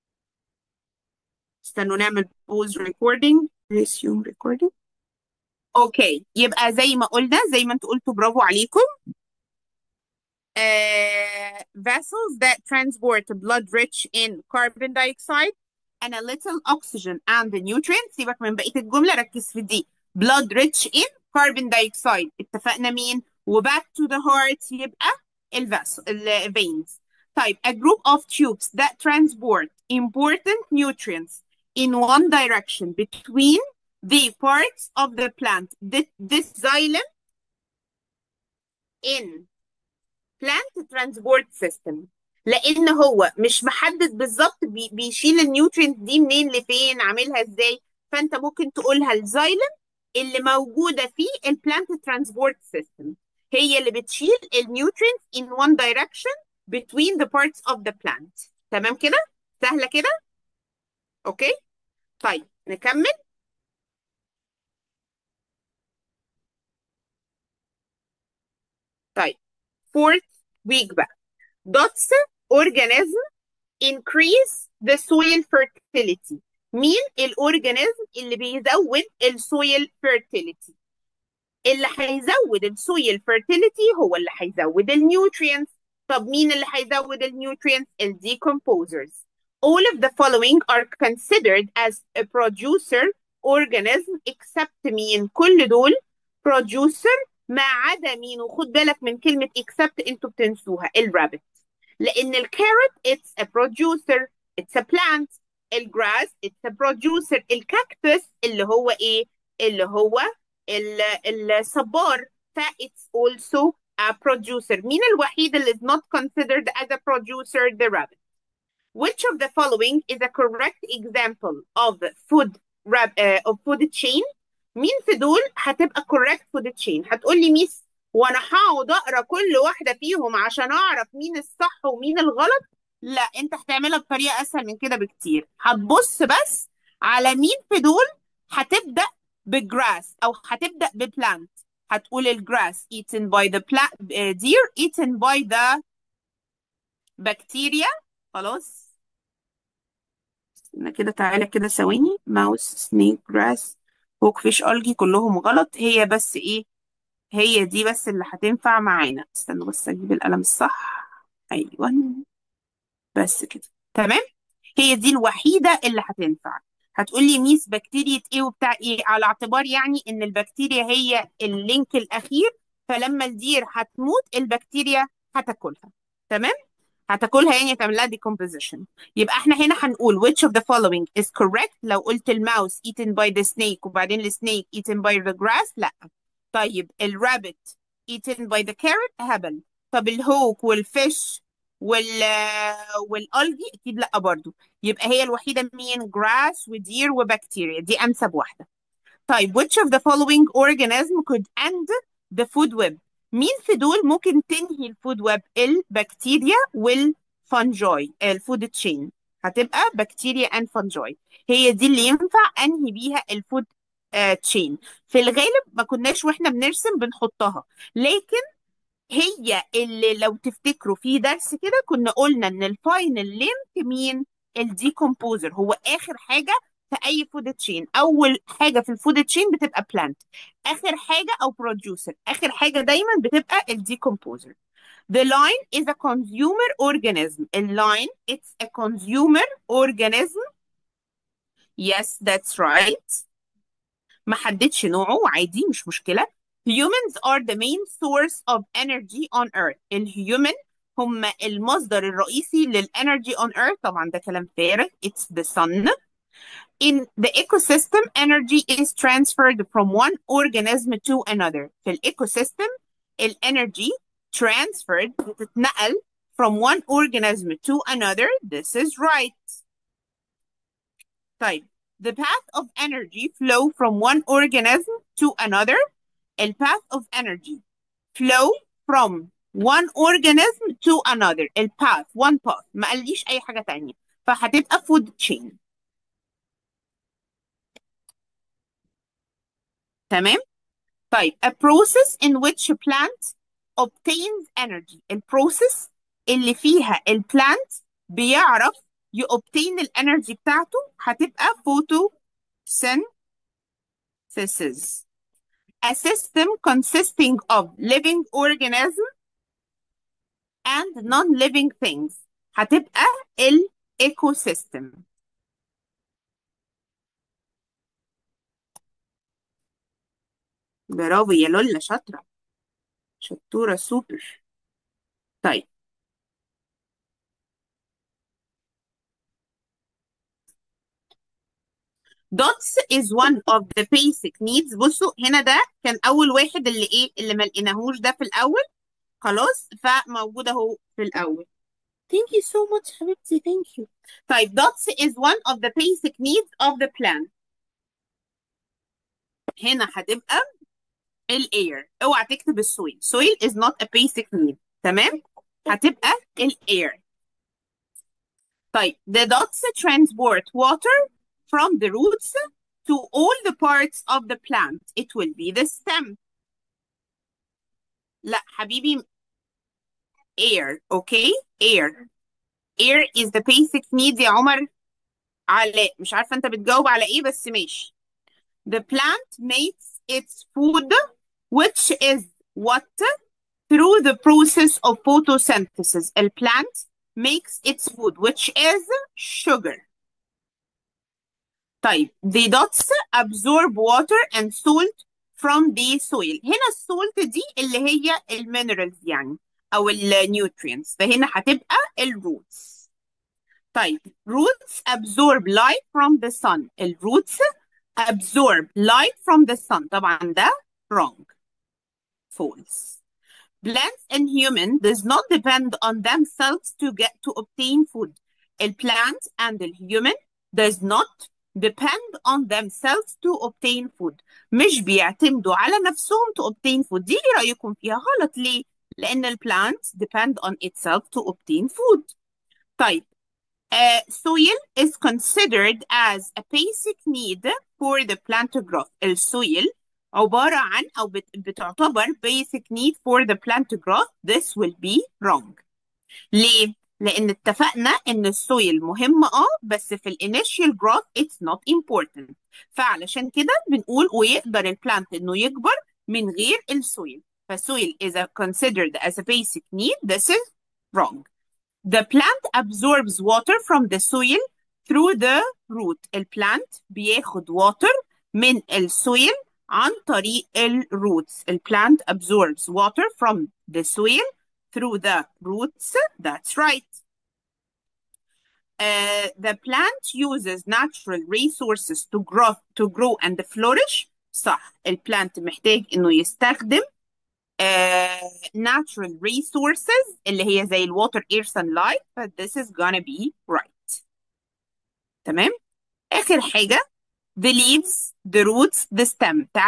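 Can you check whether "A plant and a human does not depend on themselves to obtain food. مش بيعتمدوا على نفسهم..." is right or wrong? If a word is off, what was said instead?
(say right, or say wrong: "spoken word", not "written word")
right.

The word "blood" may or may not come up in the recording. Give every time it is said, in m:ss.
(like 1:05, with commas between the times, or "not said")
0:13, 0:20.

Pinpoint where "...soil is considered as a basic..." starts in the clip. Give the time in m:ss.
7:14.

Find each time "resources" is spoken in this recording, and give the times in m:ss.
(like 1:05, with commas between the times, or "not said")
8:01, 8:09.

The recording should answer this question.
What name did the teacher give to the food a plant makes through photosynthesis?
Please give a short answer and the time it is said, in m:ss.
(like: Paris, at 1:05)
sugar, at 6:29.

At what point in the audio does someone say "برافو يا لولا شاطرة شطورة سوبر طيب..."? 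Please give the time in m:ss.
5:20.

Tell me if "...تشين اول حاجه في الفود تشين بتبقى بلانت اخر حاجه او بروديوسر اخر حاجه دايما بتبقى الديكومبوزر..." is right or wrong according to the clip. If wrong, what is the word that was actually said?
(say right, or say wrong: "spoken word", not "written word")
right.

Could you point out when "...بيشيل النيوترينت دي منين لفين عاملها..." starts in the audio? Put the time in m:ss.
0:44.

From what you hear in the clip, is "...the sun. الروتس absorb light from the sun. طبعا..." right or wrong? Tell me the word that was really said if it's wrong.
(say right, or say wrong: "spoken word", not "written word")
right.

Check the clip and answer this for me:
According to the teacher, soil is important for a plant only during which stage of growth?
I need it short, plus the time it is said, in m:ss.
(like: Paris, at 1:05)
initial growth, at 7:30.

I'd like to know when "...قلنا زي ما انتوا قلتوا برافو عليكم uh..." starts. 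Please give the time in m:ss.
0:07.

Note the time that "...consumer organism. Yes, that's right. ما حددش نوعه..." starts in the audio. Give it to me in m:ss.
3:58.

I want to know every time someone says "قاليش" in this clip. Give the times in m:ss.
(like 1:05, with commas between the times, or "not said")
4:42.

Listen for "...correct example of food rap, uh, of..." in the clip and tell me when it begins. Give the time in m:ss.
2:00.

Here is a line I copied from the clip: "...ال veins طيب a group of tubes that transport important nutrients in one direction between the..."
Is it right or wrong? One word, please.
right.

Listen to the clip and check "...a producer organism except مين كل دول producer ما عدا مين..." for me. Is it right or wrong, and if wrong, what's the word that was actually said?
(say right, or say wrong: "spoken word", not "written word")
right.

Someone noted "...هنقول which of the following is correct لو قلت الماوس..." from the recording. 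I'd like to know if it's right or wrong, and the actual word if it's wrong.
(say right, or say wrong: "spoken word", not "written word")
right.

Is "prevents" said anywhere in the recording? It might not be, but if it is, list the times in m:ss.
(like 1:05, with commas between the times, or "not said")
not said.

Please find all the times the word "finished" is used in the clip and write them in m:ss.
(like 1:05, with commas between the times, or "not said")
not said.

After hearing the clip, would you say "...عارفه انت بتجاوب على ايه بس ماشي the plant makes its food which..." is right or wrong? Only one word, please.
right.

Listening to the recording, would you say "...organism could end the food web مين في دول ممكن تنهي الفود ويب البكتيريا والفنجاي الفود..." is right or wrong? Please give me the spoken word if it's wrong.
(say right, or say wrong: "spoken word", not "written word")
right.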